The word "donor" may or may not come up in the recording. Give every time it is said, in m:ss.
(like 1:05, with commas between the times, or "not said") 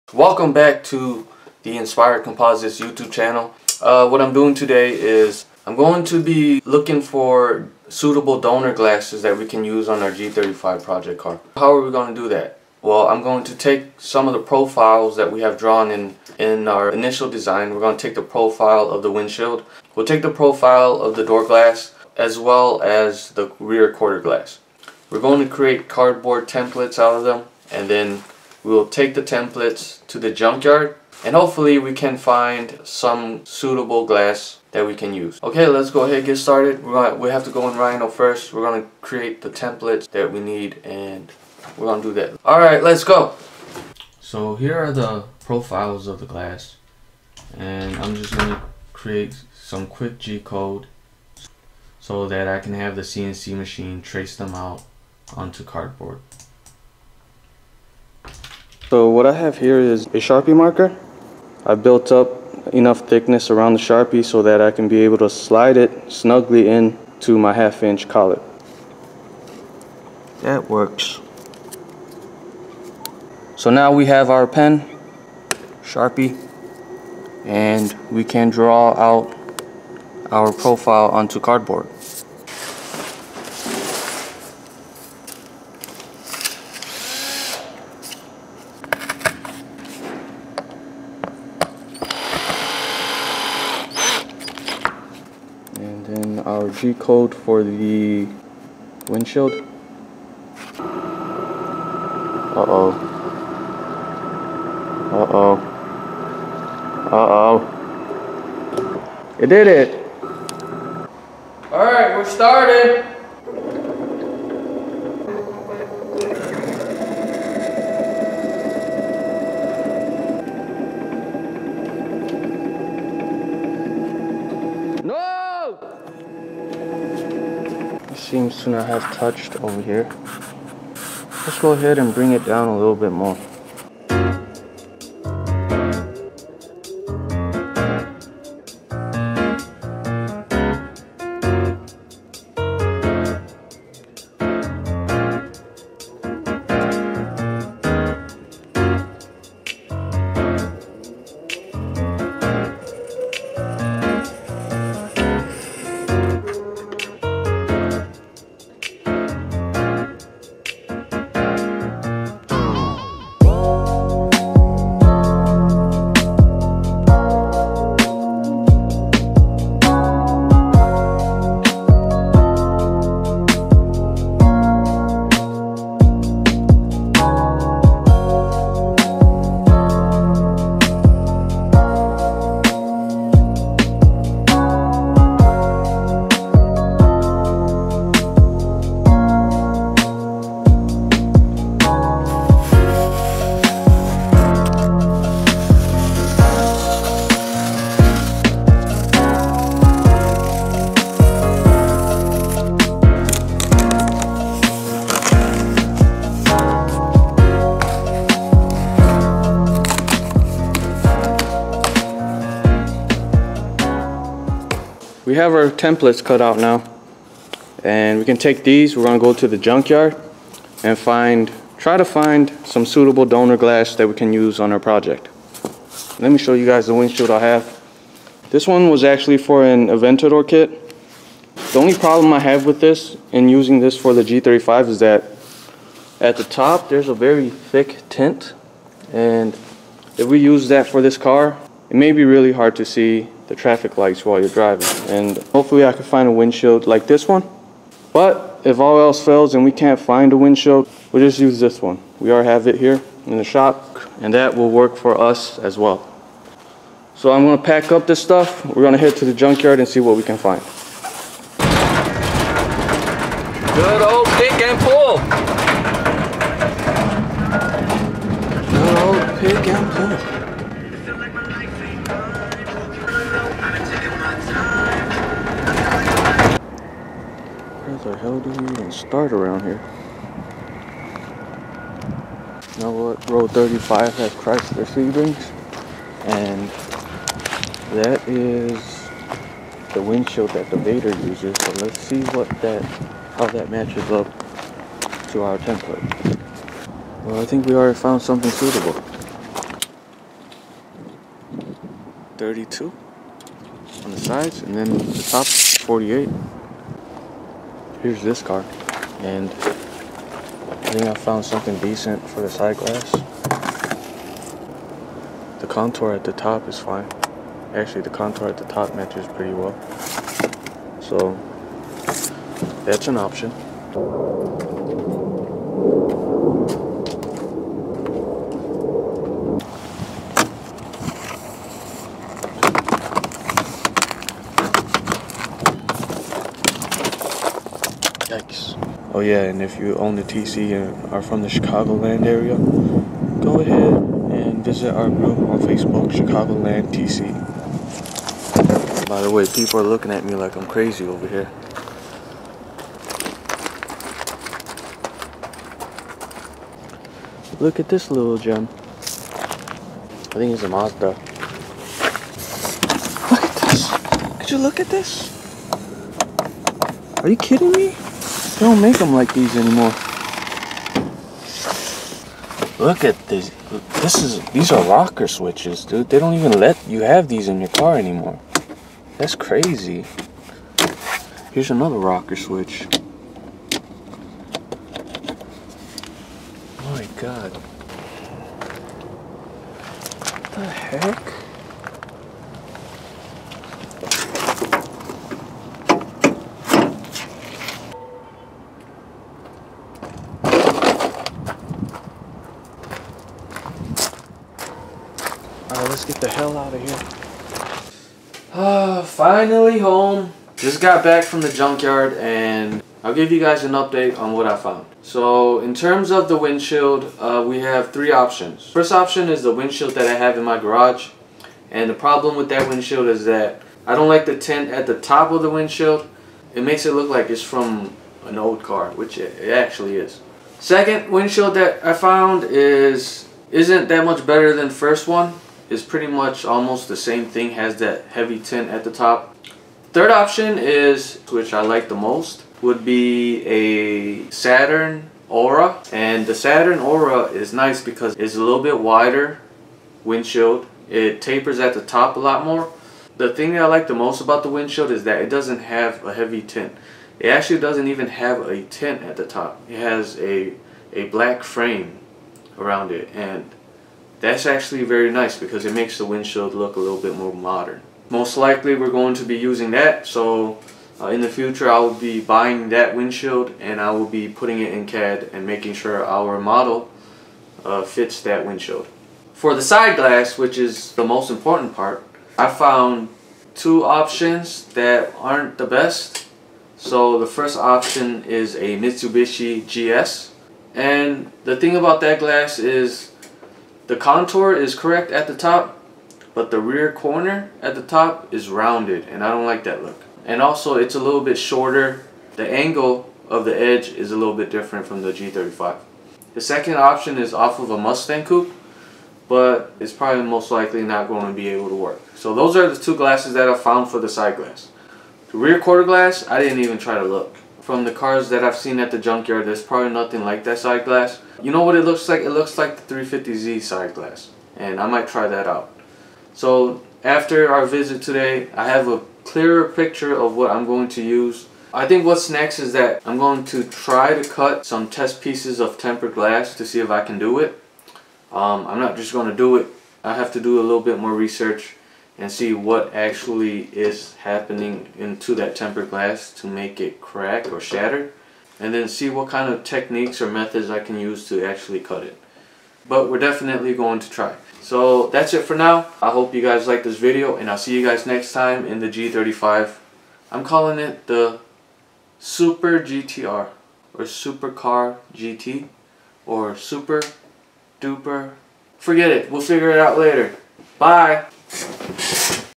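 0:08, 3:43.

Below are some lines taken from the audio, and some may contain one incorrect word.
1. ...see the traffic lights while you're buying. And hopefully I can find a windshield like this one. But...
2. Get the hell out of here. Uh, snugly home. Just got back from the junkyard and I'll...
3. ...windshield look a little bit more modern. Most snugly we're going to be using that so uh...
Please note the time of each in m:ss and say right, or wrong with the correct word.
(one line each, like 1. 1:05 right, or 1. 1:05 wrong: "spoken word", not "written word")
1. 4:02 wrong: "driving", not "buying"
2. 6:46 wrong: "finally", not "snugly"
3. 7:46 wrong: "likely", not "snugly".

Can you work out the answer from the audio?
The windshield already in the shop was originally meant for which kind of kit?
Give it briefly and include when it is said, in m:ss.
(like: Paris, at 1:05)
Aventador, at 3:49.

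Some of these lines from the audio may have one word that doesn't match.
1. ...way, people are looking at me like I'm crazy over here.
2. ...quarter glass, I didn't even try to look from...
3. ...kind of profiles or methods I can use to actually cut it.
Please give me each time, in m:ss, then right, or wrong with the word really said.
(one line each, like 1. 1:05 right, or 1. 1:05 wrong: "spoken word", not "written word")
1. 5:49 right
2. 8:35 right
3. 9:09 wrong: "techniques", not "profiles".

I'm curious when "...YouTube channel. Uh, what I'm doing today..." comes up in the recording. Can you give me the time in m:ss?
0:02.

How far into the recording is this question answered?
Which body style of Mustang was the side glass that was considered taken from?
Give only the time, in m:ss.
8:27.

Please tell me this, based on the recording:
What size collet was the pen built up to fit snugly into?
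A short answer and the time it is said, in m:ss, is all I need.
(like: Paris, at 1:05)
half inch, at 1:07.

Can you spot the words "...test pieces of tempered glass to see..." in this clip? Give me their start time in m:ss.
8:54.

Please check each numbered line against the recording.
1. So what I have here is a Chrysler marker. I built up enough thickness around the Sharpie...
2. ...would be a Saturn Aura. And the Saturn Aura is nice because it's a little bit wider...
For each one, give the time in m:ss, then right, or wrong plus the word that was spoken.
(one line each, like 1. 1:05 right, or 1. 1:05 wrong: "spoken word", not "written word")
1. 0:58 wrong: "Sharpie", not "Chrysler"
2. 7:22 right.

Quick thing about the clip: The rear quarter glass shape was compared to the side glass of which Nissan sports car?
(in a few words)
350Z.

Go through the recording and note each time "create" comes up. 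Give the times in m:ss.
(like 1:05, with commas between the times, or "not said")
0:25, 0:39, 0:48.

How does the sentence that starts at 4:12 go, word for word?
We already have it here in the shop and that will work for us as well.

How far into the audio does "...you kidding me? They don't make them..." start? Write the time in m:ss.
6:07.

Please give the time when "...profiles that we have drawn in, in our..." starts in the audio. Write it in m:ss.
0:14.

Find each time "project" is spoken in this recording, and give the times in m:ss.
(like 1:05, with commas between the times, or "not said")
0:10, 3:44.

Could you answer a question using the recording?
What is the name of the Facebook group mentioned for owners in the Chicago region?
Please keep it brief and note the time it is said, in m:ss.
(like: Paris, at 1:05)
Chicagoland TC, at 5:46.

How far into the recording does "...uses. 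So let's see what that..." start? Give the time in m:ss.
4:51.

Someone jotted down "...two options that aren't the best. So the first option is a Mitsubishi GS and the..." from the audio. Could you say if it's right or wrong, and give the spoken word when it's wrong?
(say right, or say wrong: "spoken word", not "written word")
right.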